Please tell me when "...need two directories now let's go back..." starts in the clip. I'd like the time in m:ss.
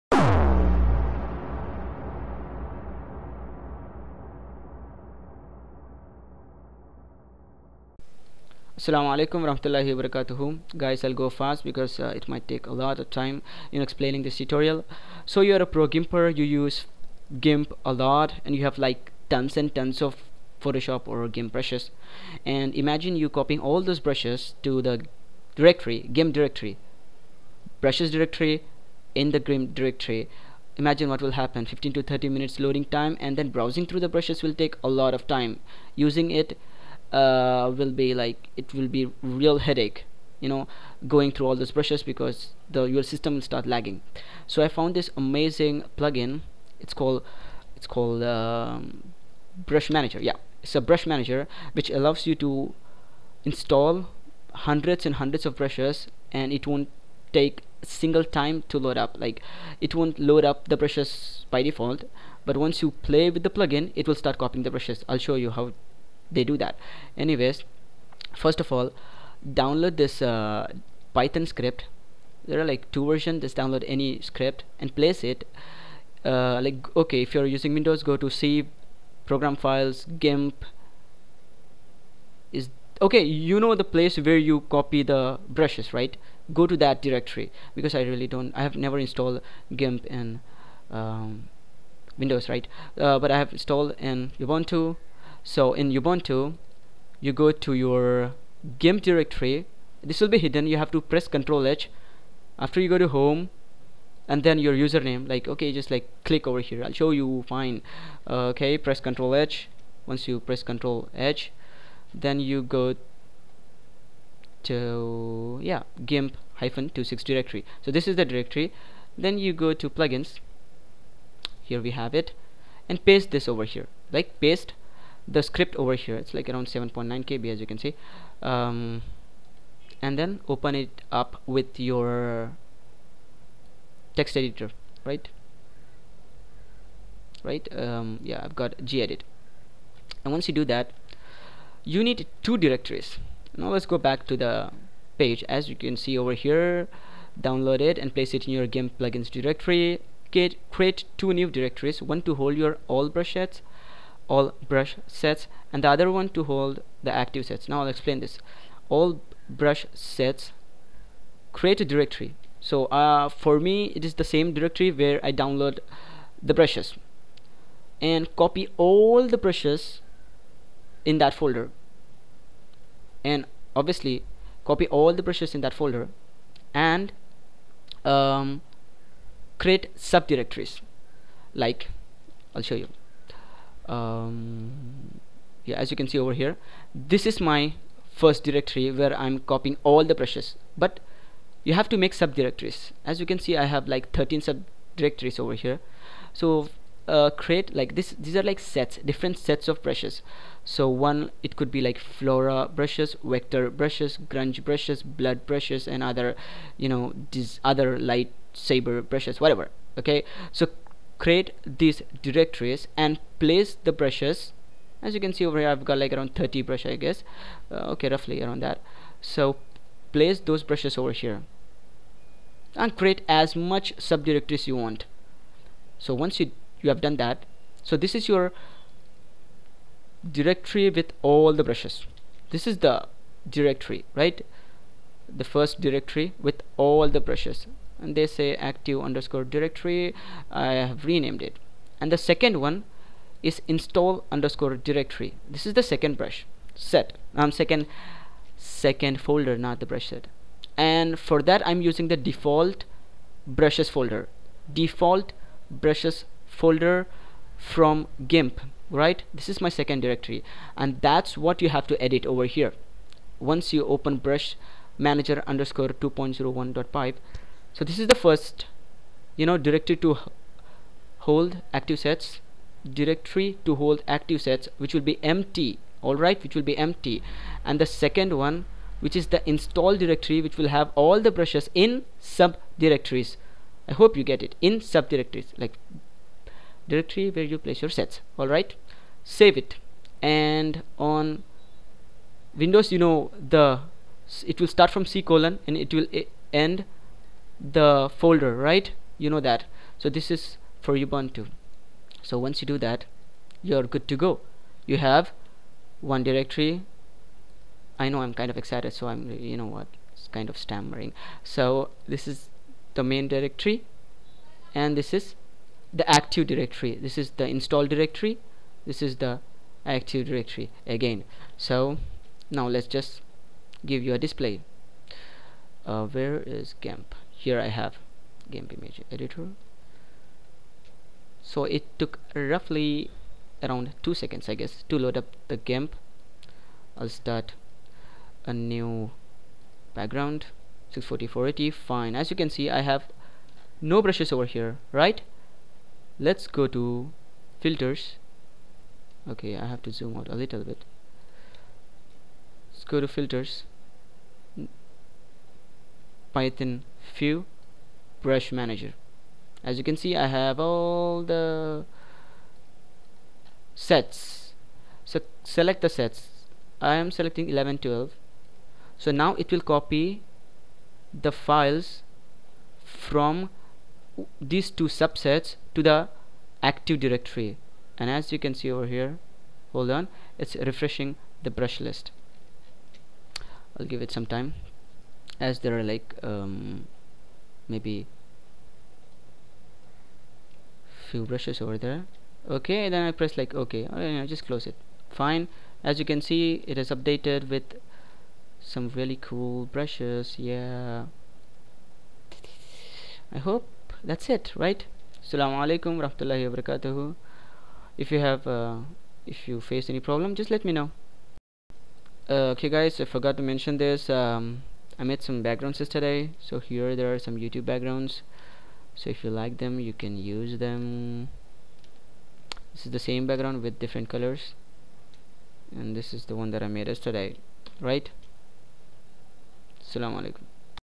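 2:22.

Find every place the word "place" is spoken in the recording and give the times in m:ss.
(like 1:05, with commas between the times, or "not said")
1:14, 1:23, 2:28, 3:33, 3:40, 4:47.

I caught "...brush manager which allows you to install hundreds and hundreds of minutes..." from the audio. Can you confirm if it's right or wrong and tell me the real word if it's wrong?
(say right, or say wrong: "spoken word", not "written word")
wrong: "brushes", not "minutes".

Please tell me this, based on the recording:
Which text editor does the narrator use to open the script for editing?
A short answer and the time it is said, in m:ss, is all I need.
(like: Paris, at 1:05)
gedit, at 2:18.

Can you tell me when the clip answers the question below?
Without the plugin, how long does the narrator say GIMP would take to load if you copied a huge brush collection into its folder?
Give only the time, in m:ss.
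0:31.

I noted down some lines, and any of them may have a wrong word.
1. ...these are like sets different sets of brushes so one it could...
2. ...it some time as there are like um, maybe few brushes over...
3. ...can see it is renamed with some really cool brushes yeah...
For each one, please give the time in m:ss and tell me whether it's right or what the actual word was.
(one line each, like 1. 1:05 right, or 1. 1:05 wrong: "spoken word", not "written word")
1. 3:18 right
2. 6:24 right
3. 6:36 wrong: "updated", not "renamed".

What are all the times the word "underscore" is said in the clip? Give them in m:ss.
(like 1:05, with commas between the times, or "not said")
3:58, 4:04, 4:25.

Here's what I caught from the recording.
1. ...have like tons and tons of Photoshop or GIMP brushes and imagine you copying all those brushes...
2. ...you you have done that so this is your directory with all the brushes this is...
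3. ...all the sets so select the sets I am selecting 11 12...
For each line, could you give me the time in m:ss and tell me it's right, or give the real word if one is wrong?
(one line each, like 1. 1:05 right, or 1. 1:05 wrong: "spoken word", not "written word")
1. 0:18 right
2. 3:46 right
3. 6:00 right.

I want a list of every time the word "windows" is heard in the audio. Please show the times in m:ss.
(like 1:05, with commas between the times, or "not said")
1:17, 1:32, 4:52.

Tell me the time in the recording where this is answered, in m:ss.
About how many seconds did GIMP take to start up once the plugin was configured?
5:34.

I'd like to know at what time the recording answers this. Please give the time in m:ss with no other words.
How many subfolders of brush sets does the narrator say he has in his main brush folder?
3:14.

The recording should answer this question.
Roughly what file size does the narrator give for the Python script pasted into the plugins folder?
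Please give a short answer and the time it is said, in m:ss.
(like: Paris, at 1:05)
7.9 KB, at 2:06.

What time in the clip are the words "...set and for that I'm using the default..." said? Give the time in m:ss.
4:10.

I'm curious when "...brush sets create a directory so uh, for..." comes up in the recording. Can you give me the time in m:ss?
2:39.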